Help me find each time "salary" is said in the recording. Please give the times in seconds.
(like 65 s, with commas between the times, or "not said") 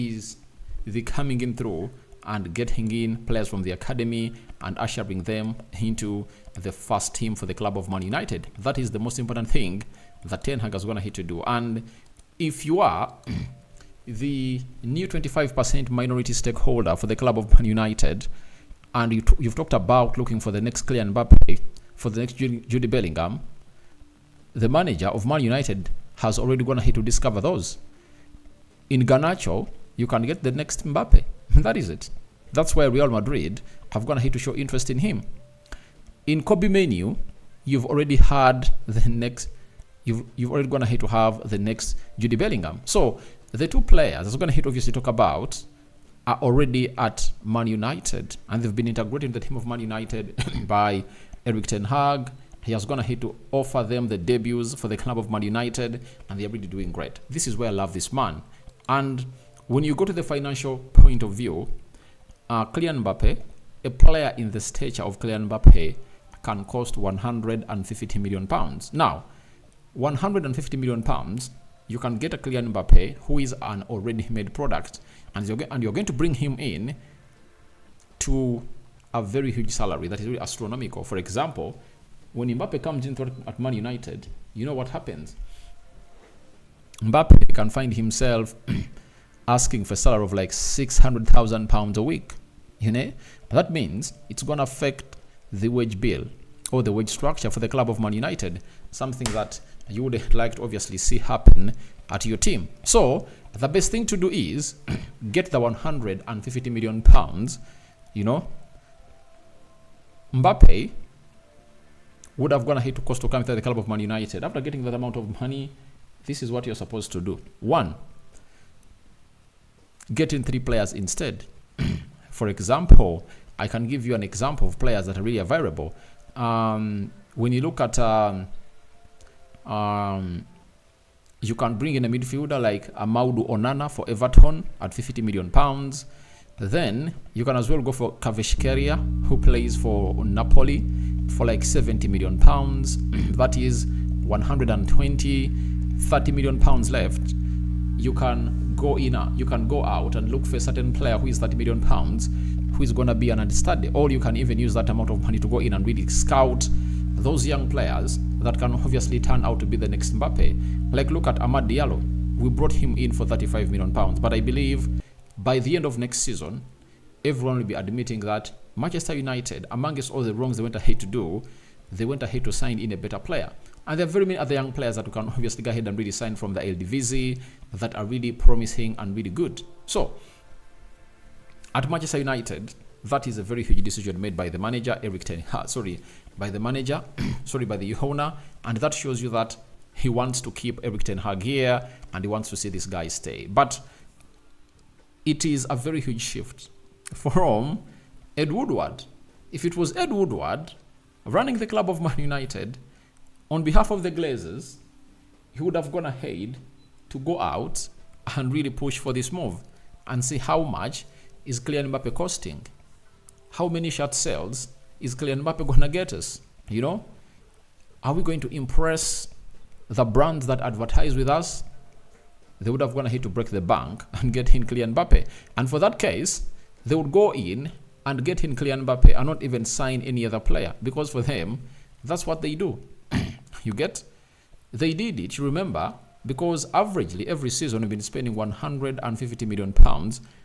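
79 s, 89 s.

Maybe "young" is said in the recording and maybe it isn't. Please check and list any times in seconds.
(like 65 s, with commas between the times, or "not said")
157 s, 174 s.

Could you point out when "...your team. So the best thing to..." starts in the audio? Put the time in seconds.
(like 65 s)
102 s.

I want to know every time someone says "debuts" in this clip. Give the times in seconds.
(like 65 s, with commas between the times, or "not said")
54 s.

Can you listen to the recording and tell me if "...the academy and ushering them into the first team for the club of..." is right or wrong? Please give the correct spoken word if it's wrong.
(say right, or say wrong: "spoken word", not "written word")
right.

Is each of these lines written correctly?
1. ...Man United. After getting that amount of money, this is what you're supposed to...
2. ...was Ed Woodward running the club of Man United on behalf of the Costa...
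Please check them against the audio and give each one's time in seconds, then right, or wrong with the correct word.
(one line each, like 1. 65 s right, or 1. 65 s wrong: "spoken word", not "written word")
1. 113 s right
2. 199 s wrong: "Glazers", not "Costa".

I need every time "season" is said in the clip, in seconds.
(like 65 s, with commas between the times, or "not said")
166 s, 237 s.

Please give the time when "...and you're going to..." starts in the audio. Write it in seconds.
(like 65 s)
75 s.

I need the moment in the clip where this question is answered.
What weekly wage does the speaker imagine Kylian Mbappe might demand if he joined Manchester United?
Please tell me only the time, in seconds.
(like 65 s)
90 s.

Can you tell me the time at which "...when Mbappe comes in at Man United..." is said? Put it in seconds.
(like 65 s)
82 s.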